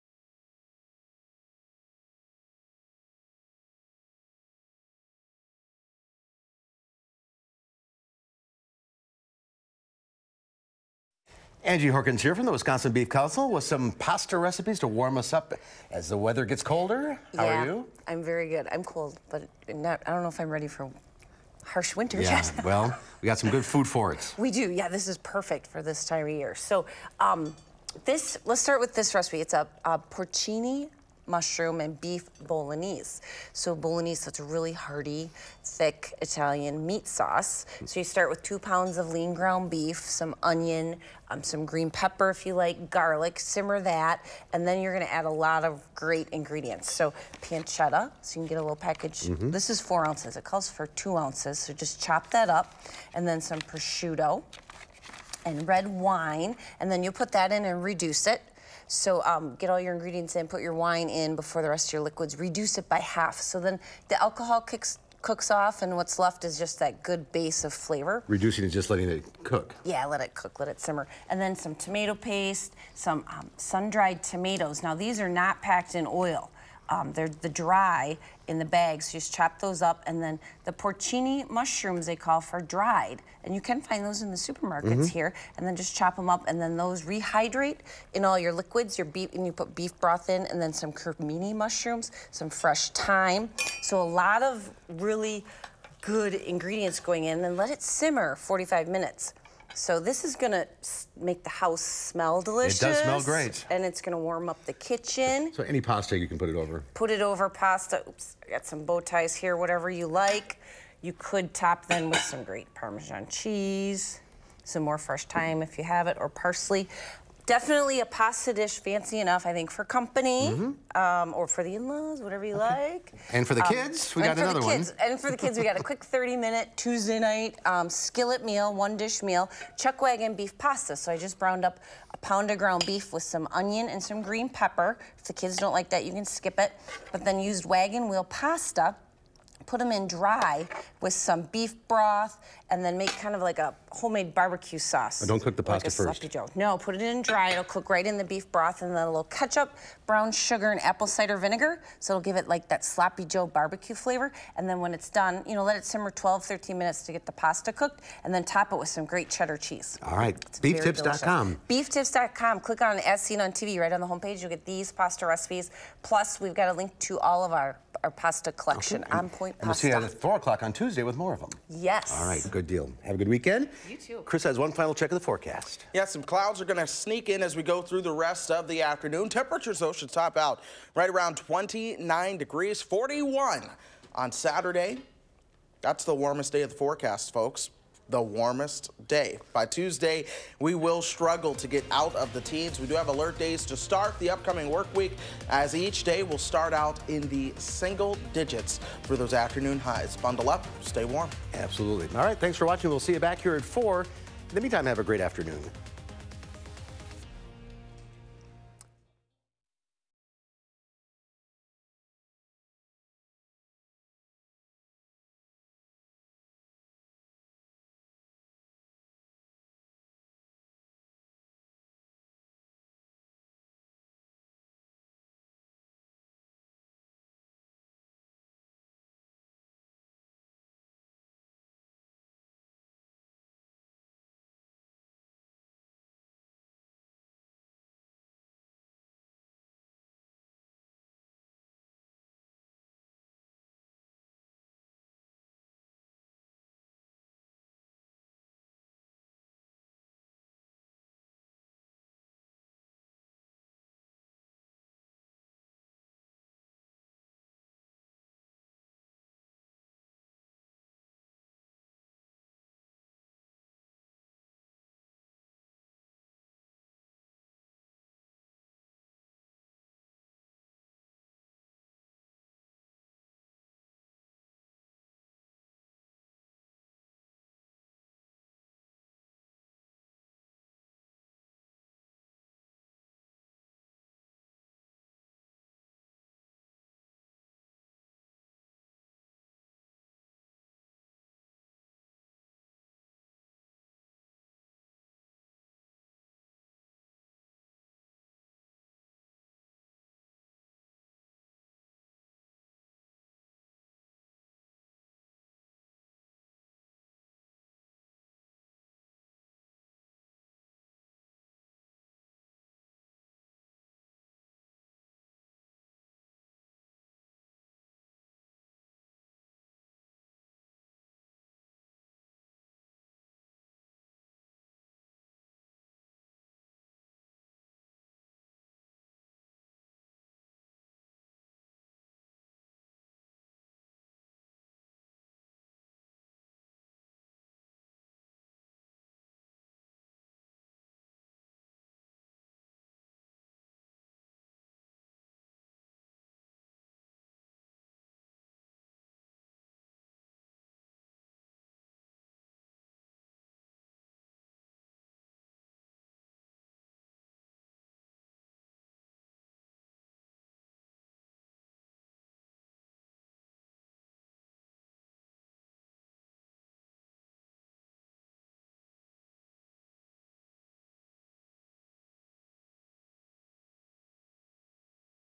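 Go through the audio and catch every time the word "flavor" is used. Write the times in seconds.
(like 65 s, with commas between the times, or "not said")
67 s, 153 s.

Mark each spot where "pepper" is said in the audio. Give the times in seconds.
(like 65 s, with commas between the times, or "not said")
41 s, 134 s.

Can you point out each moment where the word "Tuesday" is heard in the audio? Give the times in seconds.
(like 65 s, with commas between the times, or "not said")
126 s, 170 s, 189 s.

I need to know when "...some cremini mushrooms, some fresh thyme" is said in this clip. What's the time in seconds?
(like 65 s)
90 s.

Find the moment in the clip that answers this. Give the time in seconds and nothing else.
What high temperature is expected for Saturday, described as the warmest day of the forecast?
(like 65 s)
182 s.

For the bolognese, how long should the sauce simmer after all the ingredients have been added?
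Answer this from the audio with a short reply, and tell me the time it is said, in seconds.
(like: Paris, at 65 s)
45 minutes, at 98 s.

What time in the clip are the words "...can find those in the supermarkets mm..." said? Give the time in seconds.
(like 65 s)
83 s.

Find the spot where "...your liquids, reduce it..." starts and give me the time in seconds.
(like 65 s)
61 s.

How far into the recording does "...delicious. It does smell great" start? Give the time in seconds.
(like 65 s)
102 s.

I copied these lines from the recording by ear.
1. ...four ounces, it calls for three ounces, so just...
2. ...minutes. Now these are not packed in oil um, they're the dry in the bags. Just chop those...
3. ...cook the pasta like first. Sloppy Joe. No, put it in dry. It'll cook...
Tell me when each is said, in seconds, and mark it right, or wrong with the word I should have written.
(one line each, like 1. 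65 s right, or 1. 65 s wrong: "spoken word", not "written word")
1. 49 s wrong: "two", not "three"
2. 74 s wrong: "tomatoes", not "minutes"
3. 145 s right.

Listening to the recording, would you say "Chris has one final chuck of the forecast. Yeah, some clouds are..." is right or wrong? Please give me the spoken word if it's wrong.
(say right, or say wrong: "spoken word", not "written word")
wrong: "check", not "chuck".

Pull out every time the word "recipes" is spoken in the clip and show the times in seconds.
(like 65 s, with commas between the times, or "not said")
14 s, 29 s, 165 s.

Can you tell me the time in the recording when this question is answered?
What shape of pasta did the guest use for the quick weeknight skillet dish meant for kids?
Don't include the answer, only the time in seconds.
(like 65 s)
137 s.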